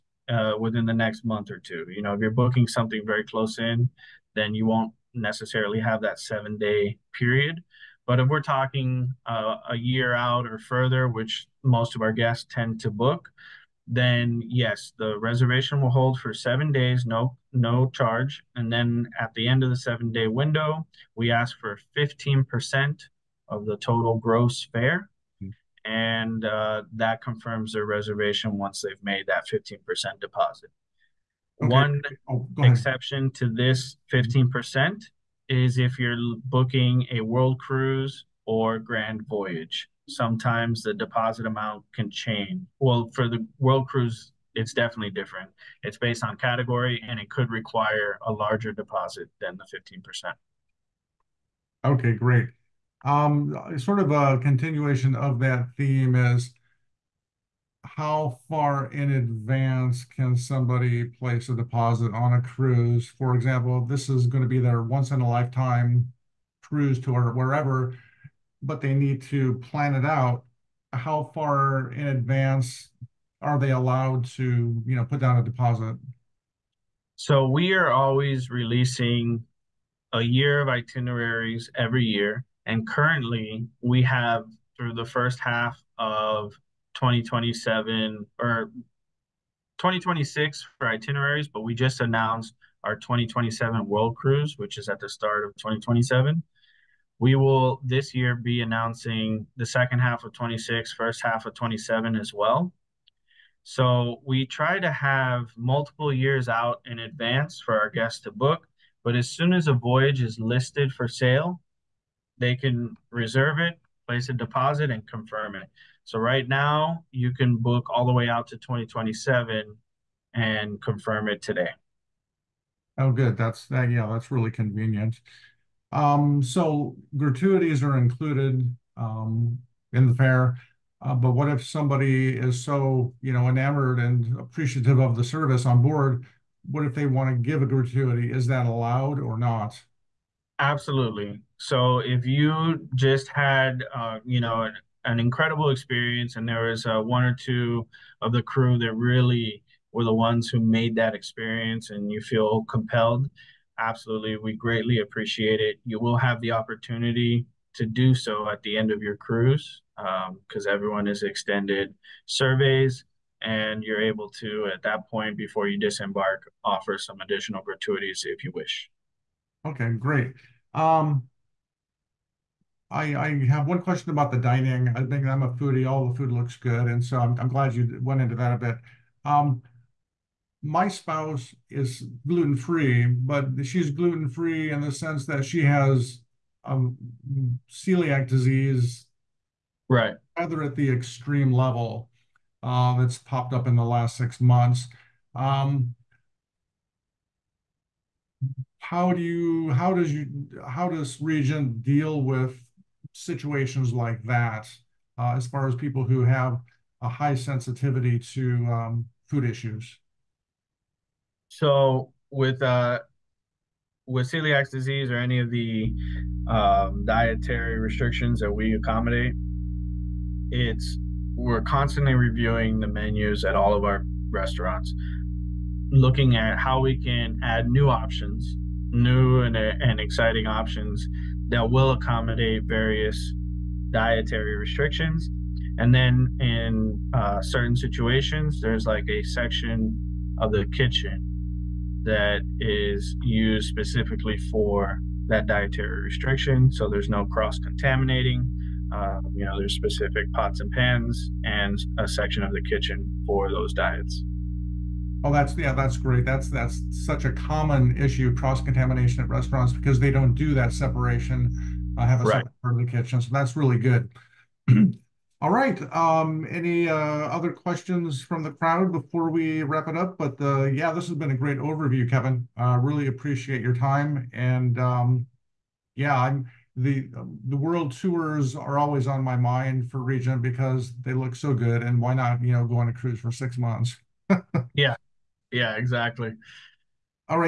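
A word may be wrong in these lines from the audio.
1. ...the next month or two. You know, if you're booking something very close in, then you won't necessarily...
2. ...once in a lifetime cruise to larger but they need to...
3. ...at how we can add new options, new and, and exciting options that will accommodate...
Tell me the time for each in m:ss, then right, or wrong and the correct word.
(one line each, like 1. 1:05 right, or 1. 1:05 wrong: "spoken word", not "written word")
1. 0:00 right
2. 1:04 wrong: "wherever", not "larger"
3. 3:46 right.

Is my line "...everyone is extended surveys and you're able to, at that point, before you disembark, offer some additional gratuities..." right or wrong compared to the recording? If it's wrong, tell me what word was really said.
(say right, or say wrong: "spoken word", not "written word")
right.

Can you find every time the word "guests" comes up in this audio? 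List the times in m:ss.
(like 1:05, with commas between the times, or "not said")
0:12, 1:47.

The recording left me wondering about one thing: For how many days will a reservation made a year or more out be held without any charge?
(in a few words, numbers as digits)
7 days.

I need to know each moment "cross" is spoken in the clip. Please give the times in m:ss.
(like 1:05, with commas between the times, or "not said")
4:07, 4:18.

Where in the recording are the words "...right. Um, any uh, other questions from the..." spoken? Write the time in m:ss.
4:25.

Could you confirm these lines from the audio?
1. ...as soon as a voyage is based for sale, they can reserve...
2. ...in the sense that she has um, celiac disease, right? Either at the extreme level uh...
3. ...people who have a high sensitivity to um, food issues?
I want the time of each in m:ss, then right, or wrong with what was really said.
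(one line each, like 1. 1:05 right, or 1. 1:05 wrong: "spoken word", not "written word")
1. 1:49 wrong: "listed", not "based"
2. 3:04 right
3. 3:25 right.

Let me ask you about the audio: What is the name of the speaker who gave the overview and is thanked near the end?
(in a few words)
Kevin.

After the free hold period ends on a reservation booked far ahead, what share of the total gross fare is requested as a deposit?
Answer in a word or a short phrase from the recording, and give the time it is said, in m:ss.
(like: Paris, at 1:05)
15%, at 0:21.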